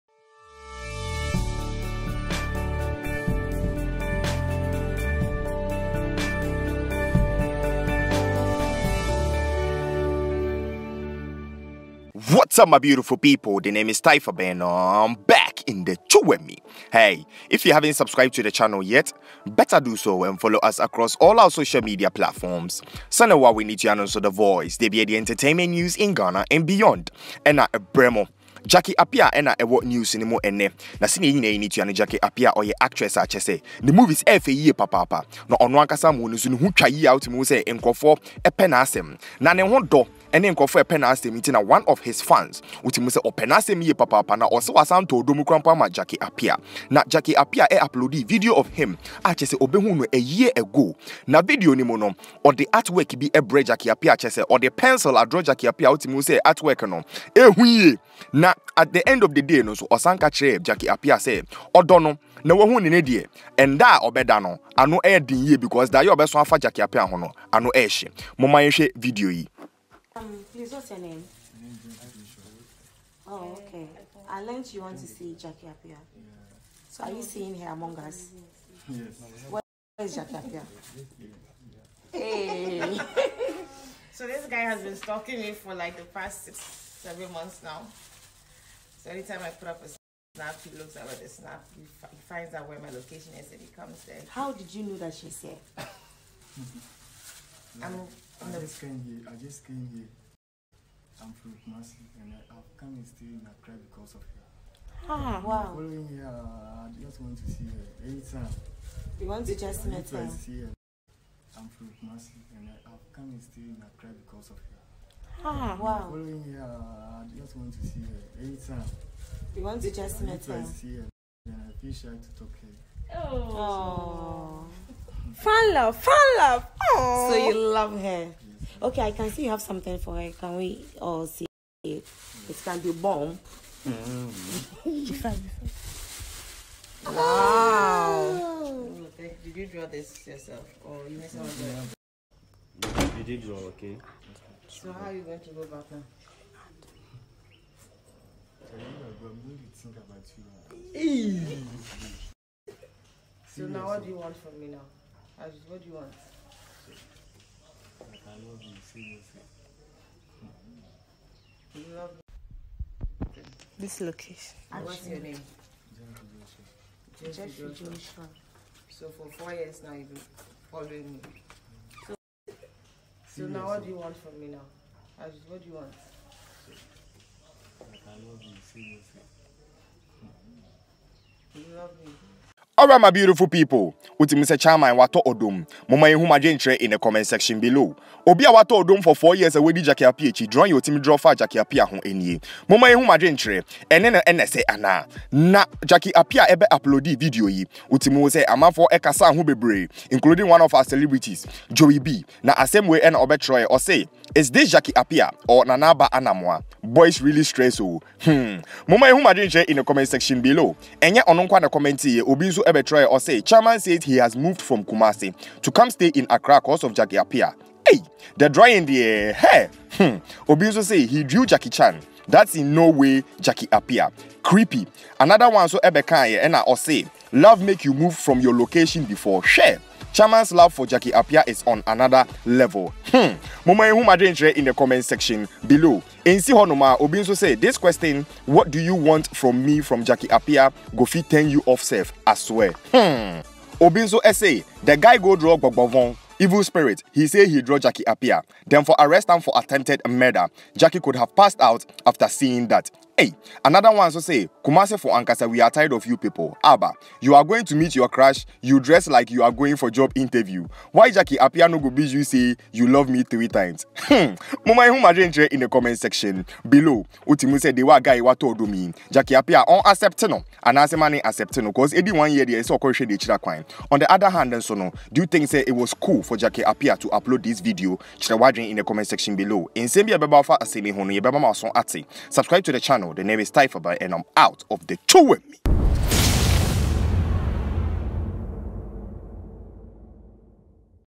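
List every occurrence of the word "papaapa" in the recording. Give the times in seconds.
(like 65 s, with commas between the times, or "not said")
34 s, 43 s.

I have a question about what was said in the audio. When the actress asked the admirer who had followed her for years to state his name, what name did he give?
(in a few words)
Jeffrey Joshua.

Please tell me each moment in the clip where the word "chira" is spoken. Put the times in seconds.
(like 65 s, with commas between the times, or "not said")
272 s, 278 s.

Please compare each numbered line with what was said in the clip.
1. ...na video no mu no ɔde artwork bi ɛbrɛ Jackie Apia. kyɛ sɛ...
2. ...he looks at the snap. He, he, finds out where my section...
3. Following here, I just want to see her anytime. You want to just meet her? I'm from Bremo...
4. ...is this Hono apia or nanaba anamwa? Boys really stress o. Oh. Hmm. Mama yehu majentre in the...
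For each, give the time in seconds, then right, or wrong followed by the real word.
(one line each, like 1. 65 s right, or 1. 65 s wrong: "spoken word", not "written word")
1. 51 s right
2. 90 s wrong: "location", not "section"
3. 105 s wrong: "Kumasi", not "Bremo"
4. 204 s wrong: "Jackie", not "Hono".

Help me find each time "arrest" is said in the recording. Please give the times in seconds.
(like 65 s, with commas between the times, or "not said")
248 s.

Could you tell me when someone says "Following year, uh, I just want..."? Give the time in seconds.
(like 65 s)
116 s.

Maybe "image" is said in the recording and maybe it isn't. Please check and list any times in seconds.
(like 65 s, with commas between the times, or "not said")
not said.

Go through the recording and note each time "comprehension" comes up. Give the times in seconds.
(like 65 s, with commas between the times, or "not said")
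not said.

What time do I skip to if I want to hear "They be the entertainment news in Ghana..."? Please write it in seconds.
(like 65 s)
24 s.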